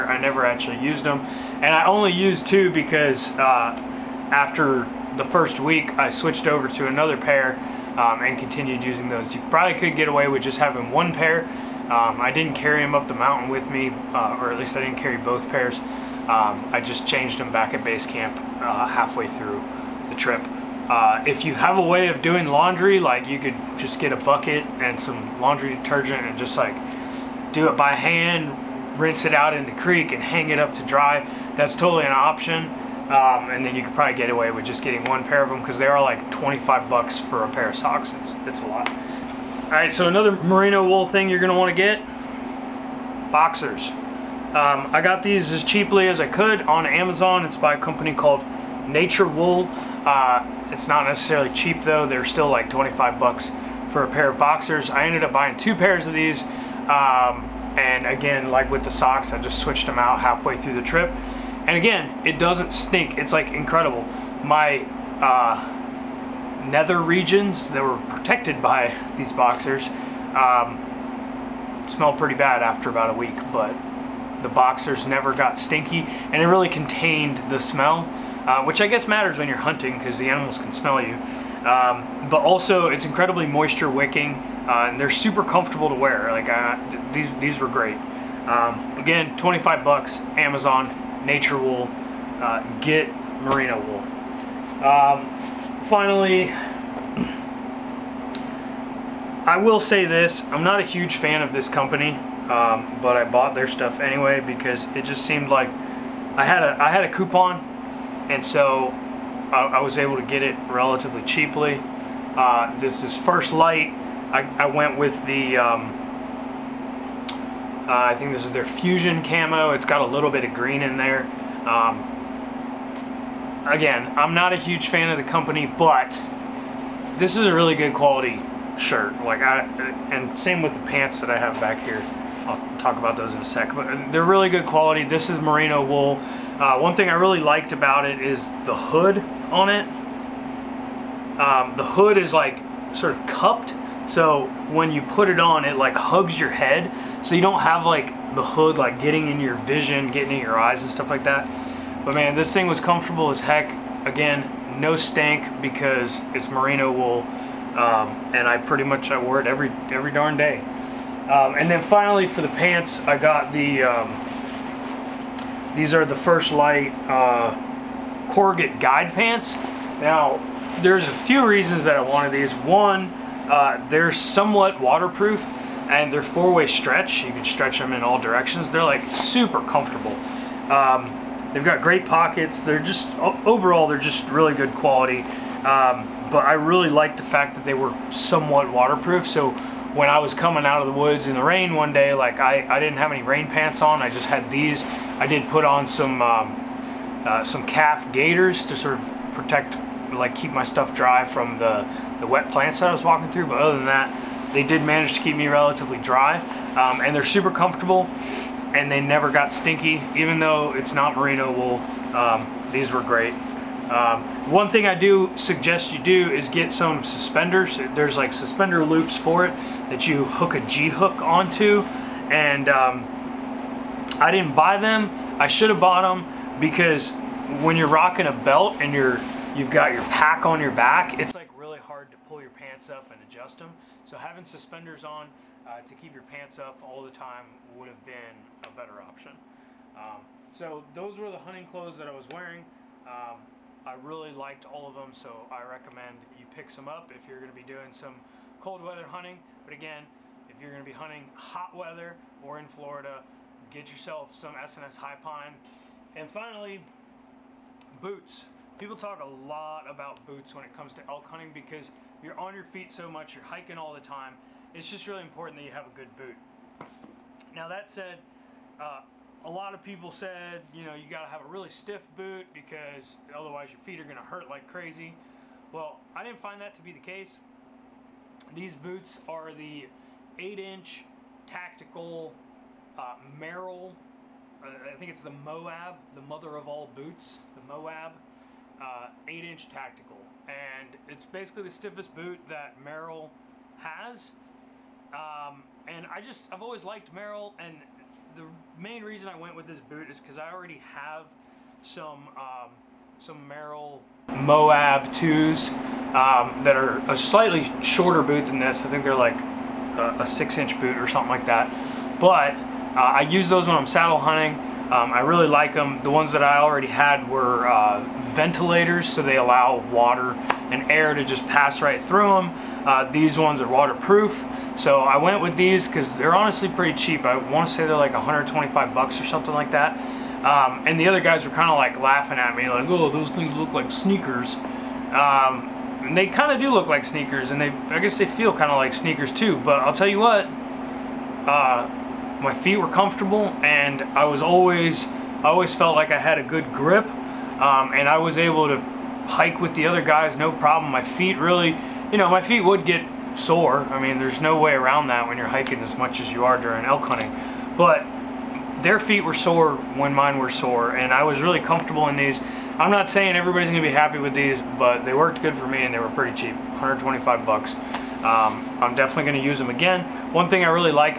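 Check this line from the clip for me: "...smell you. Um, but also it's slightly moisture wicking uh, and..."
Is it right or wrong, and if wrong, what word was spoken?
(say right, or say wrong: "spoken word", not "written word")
wrong: "incredibly", not "slightly".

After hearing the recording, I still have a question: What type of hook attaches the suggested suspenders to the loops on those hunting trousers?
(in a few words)
G-hook.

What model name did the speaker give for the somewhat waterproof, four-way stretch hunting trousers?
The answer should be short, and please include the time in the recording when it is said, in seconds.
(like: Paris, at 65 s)
Guide Pants, at 168 s.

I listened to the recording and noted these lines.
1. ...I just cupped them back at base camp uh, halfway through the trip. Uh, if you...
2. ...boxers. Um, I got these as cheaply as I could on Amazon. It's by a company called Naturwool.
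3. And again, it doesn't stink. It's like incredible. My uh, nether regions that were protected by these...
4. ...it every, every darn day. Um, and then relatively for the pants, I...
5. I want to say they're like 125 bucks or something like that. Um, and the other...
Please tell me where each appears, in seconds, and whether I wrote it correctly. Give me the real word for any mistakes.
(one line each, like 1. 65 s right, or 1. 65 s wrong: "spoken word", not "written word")
1. 16 s wrong: "changed", not "cupped"
2. 43 s right
3. 61 s right
4. 159 s wrong: "finally", not "relatively"
5. 327 s right.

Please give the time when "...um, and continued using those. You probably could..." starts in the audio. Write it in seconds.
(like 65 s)
7 s.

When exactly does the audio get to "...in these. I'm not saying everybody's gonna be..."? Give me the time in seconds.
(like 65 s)
362 s.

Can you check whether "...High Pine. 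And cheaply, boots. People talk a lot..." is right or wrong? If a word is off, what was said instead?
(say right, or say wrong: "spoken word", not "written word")
wrong: "finally", not "cheaply".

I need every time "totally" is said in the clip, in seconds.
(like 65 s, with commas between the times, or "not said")
31 s.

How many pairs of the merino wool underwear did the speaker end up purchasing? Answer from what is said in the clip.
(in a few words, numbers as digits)
2.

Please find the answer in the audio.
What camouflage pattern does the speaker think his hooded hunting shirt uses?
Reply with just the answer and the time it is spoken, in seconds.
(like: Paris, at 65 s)
Fusion, at 118 s.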